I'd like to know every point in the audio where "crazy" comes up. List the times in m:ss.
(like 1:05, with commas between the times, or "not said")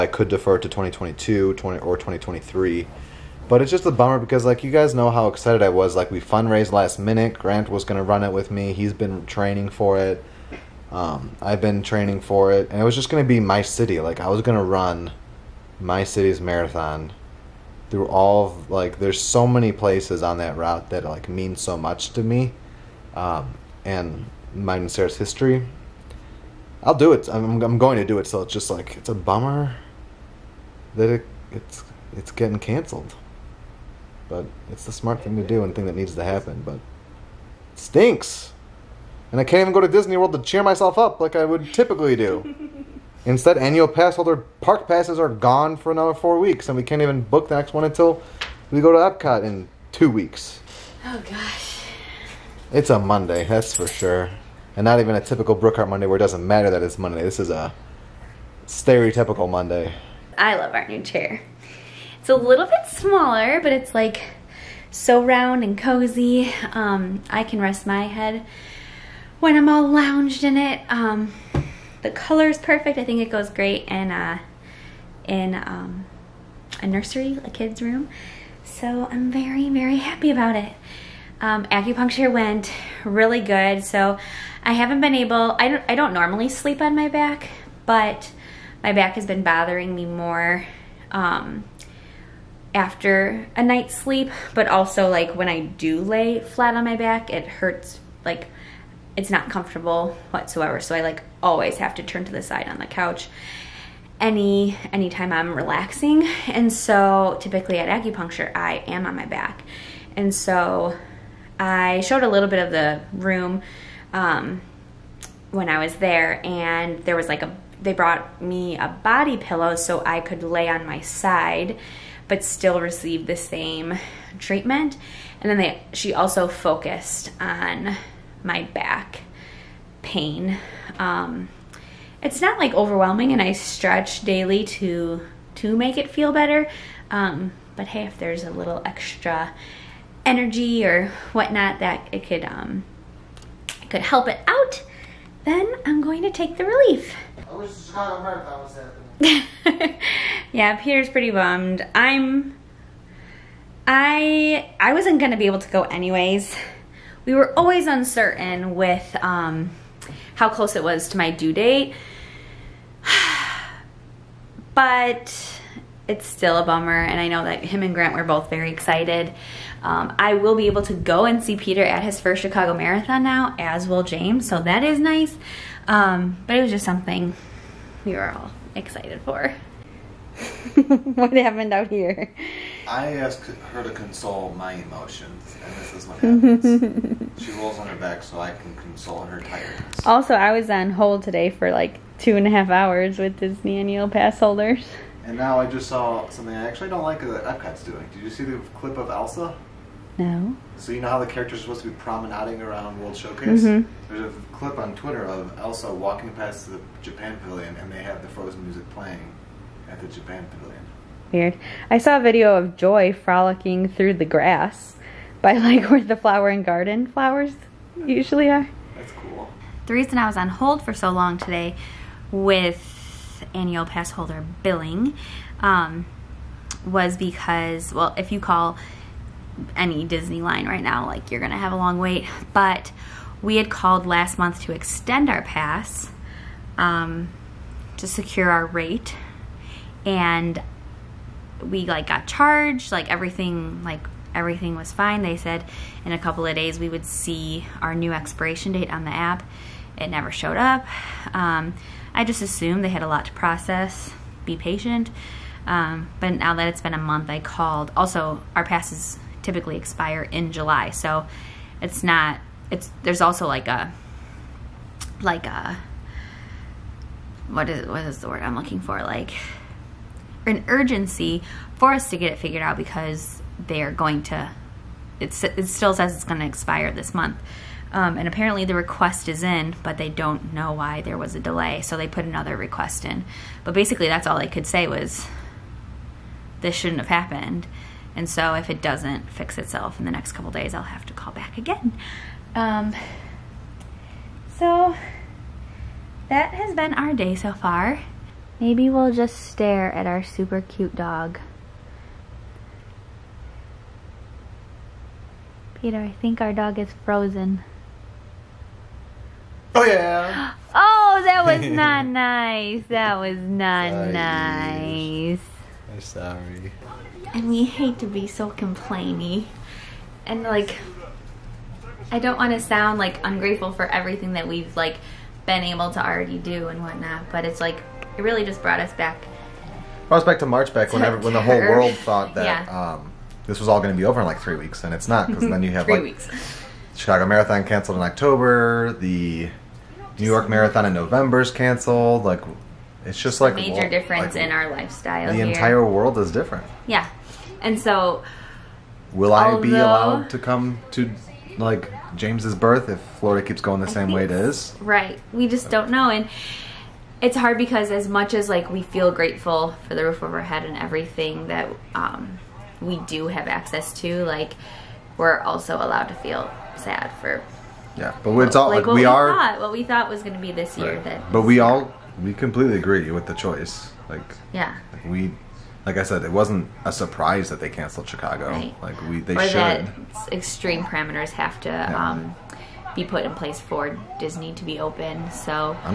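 not said.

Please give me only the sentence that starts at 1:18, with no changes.
So I'm very, very happy about it um, acupuncture went really good.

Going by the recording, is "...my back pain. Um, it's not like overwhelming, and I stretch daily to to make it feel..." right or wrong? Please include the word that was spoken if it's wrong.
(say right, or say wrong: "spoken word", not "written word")
right.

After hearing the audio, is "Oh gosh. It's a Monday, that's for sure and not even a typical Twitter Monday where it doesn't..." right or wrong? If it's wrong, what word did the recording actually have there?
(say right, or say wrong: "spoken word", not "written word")
wrong: "Brookhart", not "Twitter".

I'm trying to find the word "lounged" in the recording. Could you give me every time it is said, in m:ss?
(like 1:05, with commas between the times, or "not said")
1:09.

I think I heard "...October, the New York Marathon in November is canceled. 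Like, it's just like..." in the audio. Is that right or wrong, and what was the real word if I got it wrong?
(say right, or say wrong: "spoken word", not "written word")
right.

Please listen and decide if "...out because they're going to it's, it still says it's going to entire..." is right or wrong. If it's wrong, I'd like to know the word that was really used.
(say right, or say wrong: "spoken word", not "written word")
wrong: "expire", not "entire".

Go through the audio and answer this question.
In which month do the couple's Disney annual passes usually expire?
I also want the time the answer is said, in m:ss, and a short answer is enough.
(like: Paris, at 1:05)
July, at 4:20.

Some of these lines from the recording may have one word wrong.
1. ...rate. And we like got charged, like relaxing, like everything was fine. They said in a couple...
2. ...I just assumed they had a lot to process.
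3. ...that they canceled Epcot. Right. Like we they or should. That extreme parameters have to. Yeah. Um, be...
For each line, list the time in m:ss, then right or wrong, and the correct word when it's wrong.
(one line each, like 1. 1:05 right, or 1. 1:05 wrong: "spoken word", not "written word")
1. 3:58 wrong: "everything", not "relaxing"
2. 4:12 right
3. 6:17 wrong: "Chicago", not "Epcot".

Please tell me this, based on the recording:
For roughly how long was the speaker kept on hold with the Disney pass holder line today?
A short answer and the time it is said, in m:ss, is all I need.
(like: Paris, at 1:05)
two and a half hours, at 3:12.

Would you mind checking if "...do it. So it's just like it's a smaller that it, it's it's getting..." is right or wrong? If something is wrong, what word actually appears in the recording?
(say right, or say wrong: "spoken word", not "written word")
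wrong: "bummer", not "smaller".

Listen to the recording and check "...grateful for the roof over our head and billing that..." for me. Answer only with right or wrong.
wrong.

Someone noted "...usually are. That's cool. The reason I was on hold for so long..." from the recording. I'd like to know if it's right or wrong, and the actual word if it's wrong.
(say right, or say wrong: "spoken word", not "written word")
right.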